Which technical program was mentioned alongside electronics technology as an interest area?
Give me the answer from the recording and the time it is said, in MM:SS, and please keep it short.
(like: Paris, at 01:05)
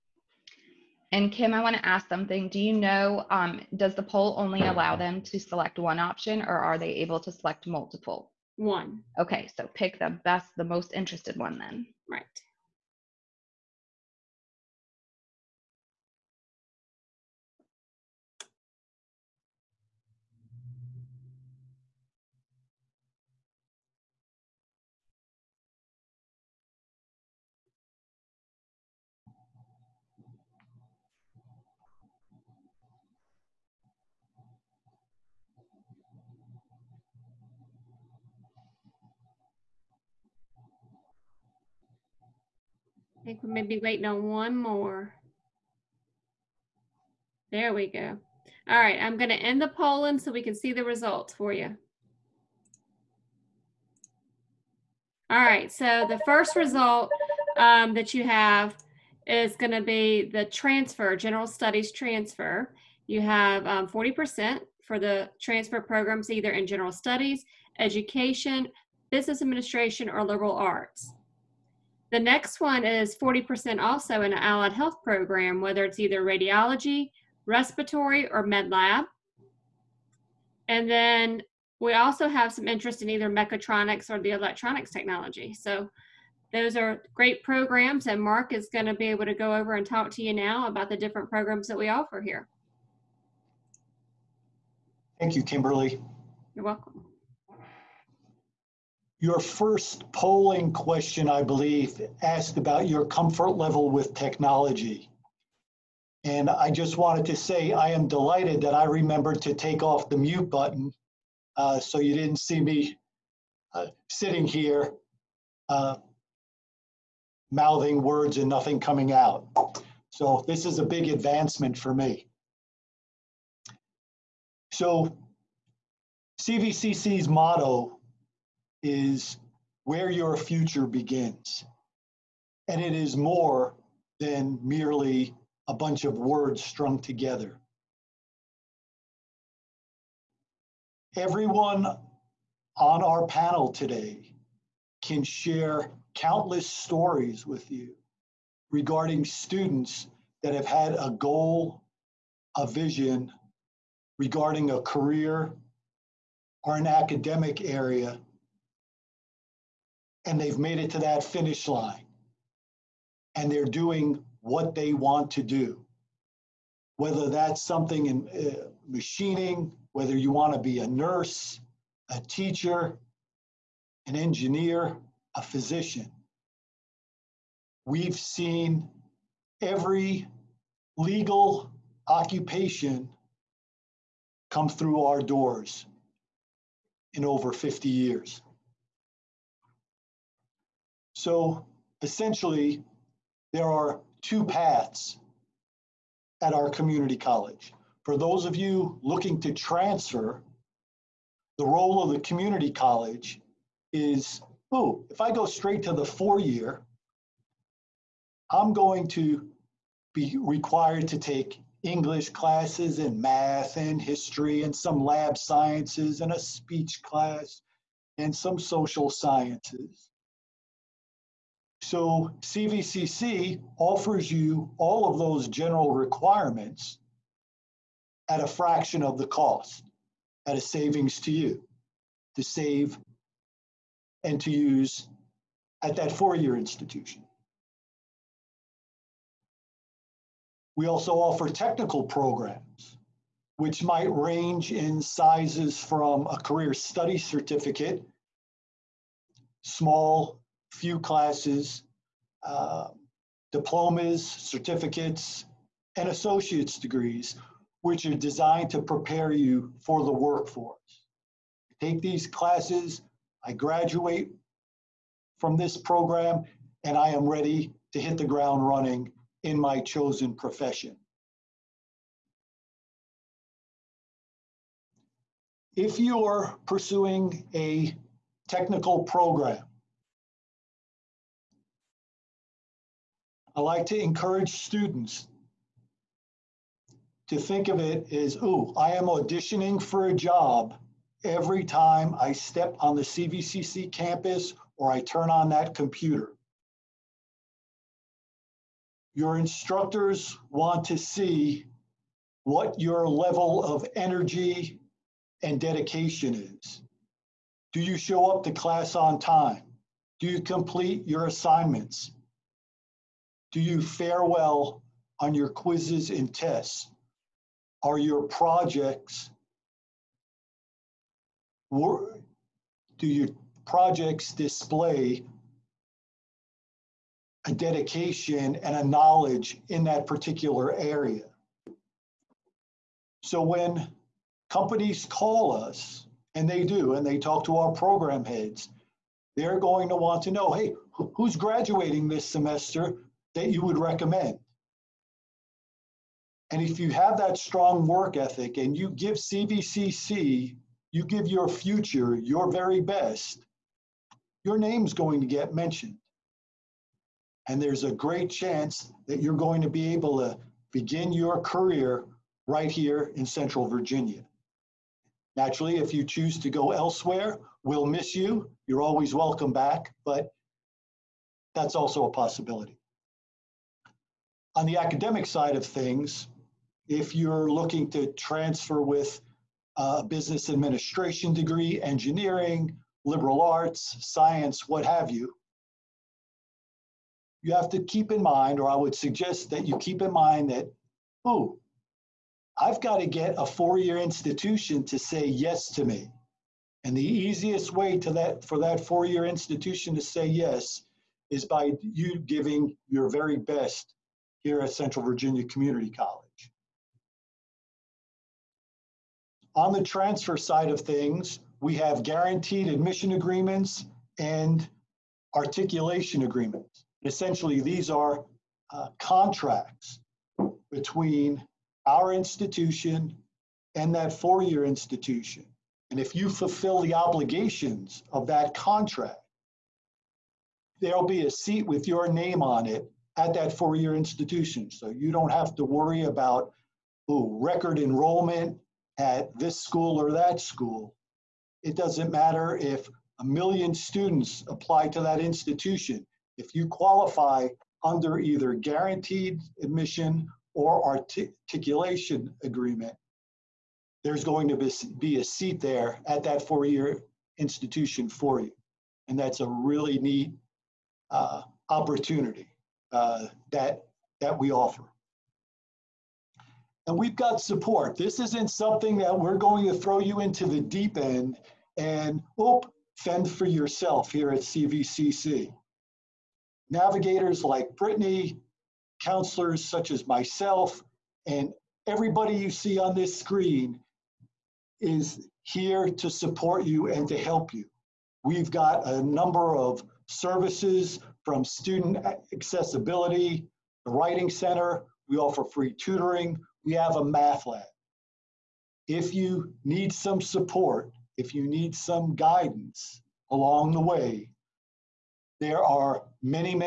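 mechatronics, at 01:23.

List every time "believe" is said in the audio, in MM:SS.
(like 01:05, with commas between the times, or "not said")
01:41.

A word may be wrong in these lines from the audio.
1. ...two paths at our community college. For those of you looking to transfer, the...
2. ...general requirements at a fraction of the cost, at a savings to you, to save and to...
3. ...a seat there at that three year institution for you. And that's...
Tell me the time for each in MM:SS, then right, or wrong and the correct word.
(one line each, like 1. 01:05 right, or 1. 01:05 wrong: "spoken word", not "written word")
1. 03:14 right
2. 03:45 right
3. 07:35 wrong: "four", not "three".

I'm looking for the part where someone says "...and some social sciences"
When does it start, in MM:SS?
03:38.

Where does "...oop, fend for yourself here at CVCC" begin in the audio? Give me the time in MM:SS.
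07:52.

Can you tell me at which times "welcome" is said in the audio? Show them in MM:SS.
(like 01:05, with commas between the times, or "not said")
01:36, 06:09.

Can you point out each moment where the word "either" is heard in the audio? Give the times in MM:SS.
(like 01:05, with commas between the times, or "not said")
01:06, 01:15, 01:23, 07:28.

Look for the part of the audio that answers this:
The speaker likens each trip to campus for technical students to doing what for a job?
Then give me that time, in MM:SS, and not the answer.
04:49.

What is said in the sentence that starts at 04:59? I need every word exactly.
Your instructors want to see what your level of energy and dedication is.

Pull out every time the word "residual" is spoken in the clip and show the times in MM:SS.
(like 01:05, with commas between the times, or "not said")
not said.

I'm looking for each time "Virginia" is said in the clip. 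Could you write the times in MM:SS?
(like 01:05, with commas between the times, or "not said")
06:03, 06:45.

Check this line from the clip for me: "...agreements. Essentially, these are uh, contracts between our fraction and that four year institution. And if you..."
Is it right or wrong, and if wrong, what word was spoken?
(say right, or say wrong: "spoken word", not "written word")
wrong: "institution", not "fraction".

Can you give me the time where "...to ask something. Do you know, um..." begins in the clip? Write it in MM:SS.
00:01.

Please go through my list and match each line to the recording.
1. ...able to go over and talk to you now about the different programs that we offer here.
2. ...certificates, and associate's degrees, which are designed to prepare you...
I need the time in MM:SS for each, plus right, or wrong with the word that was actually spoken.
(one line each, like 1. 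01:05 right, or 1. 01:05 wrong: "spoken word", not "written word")
1. 01:29 right
2. 04:14 right.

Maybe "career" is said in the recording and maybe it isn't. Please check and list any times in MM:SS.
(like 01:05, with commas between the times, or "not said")
02:34, 04:06, 06:01.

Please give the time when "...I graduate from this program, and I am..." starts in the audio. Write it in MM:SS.
04:23.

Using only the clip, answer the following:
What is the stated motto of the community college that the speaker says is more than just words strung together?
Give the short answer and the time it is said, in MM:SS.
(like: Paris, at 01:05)
Where your future begins, at 02:09.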